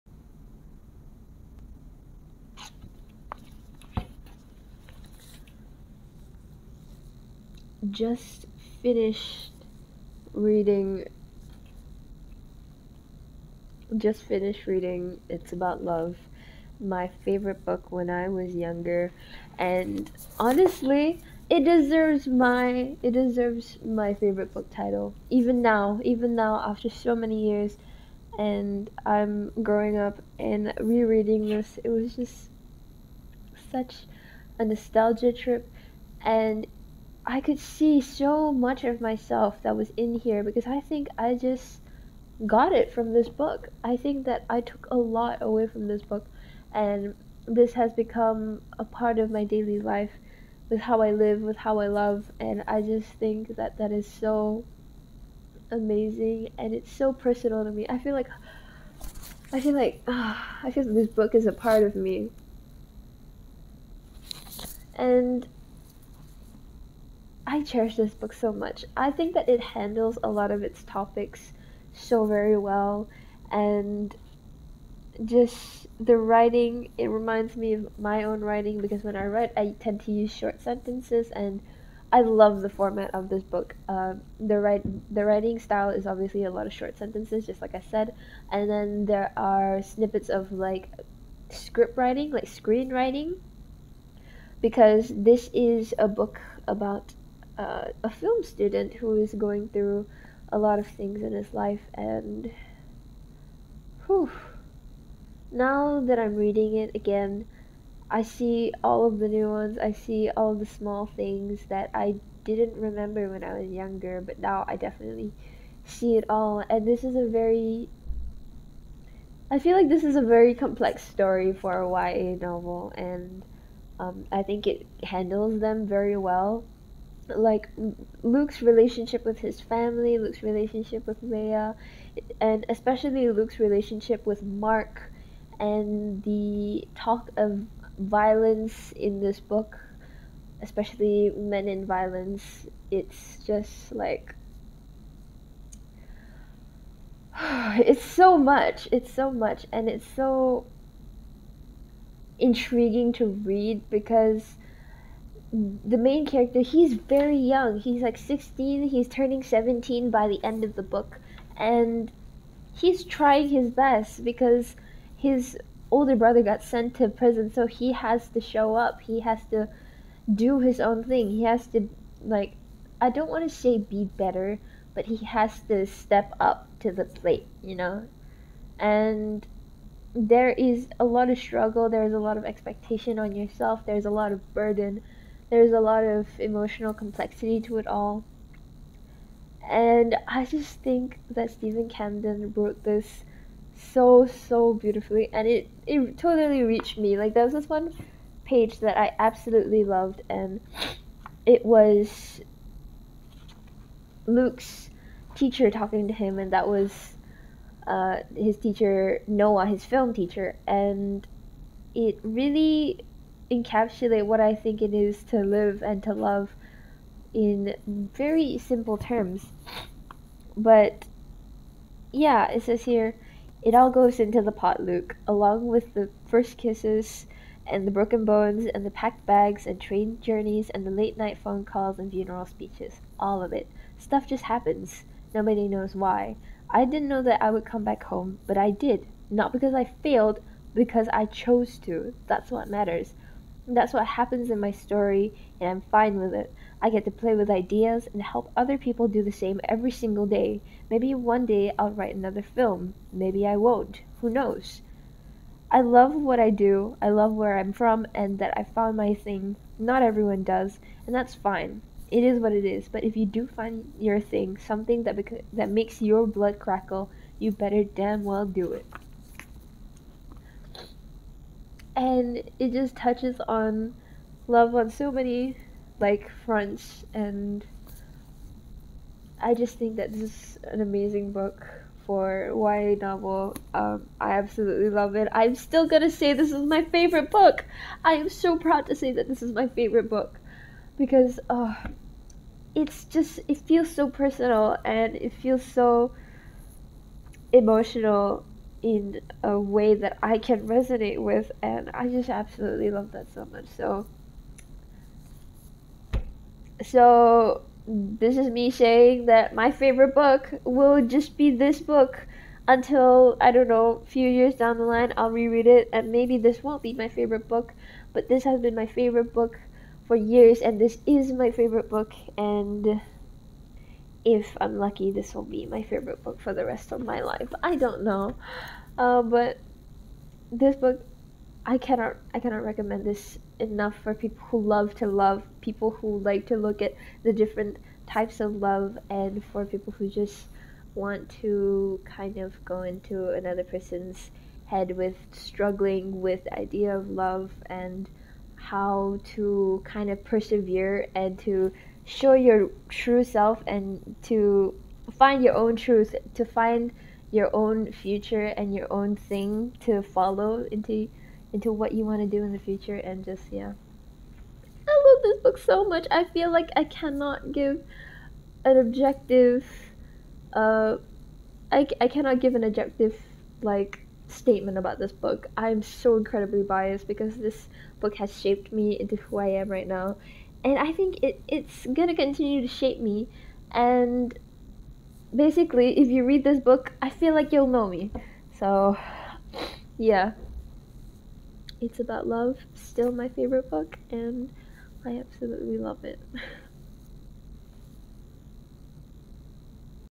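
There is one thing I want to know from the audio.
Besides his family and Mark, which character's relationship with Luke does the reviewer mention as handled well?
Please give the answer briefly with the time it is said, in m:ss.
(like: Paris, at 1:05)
Leia, at 2:11.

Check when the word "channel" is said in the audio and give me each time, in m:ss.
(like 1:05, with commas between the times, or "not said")
not said.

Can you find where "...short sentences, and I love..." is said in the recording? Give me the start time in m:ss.
1:20.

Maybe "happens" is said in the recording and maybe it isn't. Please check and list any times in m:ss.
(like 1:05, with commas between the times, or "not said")
3:54, 4:04.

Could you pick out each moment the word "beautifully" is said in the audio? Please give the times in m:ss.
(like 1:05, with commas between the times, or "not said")
3:14.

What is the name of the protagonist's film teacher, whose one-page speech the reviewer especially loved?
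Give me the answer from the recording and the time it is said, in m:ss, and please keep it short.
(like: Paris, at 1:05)
Noah, at 3:29.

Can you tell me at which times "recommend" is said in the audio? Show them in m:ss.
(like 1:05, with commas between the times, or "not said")
5:32.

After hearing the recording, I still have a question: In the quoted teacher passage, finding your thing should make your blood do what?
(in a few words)
Crackle.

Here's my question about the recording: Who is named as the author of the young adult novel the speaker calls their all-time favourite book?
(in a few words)
Steven Camden.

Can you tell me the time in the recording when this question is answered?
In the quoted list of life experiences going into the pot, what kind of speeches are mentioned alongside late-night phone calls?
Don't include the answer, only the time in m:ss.
3:52.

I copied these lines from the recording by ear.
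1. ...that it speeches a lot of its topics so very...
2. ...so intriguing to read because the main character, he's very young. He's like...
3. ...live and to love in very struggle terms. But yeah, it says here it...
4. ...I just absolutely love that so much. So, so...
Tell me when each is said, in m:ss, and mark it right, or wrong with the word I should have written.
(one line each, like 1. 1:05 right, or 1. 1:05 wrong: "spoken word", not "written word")
1. 1:09 wrong: "handles", not "speeches"
2. 2:30 right
3. 3:35 wrong: "simple", not "struggle"
4. 5:01 right.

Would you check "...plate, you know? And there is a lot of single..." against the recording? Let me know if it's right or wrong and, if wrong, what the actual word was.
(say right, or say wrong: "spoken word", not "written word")
wrong: "struggle", not "single".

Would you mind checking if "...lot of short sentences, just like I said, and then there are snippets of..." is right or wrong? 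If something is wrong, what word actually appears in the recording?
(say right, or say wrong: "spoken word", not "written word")
right.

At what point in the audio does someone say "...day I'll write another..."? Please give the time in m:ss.
4:11.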